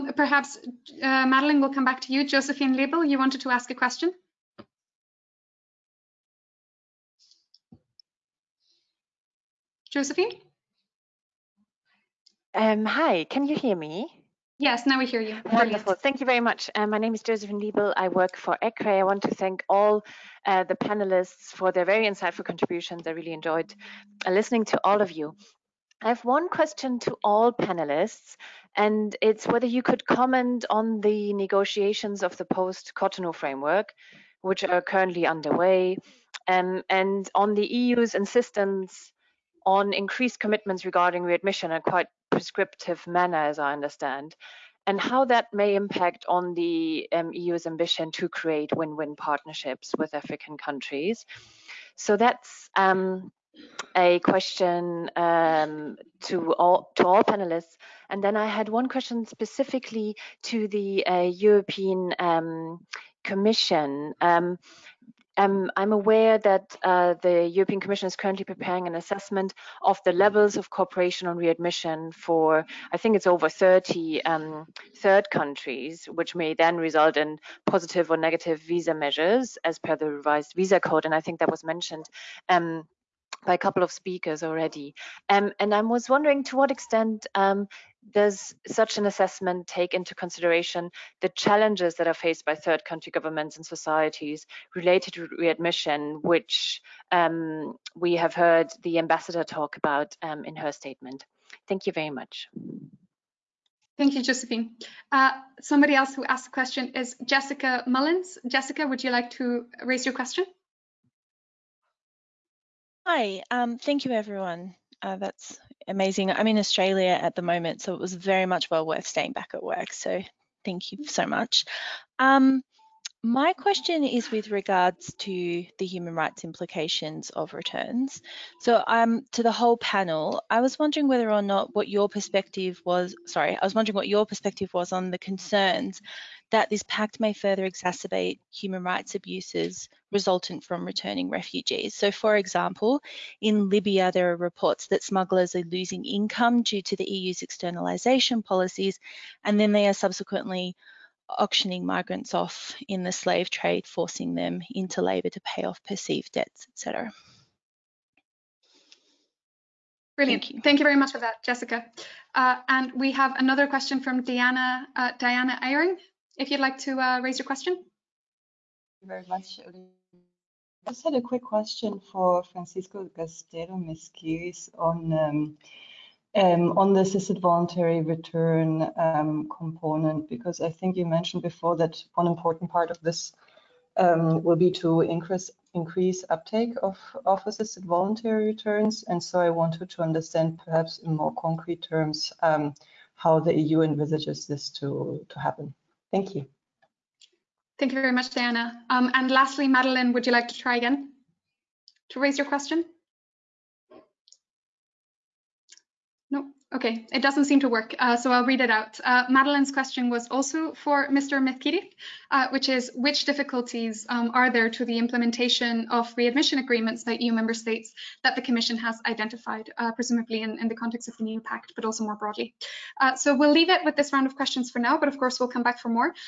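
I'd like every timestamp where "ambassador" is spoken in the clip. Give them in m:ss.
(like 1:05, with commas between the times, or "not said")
1:38.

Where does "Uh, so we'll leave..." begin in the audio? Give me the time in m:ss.
3:43.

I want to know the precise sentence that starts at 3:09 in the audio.
And so I wanted to understand perhaps in more concrete terms um, how the EU envisages this to, to happen.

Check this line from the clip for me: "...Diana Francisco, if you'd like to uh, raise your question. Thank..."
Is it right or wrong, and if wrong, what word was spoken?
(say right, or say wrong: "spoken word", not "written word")
wrong: "Eyring", not "Francisco".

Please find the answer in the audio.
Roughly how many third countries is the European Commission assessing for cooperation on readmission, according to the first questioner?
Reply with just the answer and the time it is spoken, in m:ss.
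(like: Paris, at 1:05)
over 30, at 1:13.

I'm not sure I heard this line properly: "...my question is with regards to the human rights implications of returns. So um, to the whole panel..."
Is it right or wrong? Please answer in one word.
right.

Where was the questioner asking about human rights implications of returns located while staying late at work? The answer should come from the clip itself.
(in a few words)
Australia.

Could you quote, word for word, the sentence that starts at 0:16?
Uh, my name is Josephine Liebel.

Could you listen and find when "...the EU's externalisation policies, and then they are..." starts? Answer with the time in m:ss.
2:26.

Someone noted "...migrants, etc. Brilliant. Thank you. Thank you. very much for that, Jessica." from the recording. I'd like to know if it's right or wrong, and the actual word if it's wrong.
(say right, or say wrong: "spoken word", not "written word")
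wrong: "debts", not "migrants".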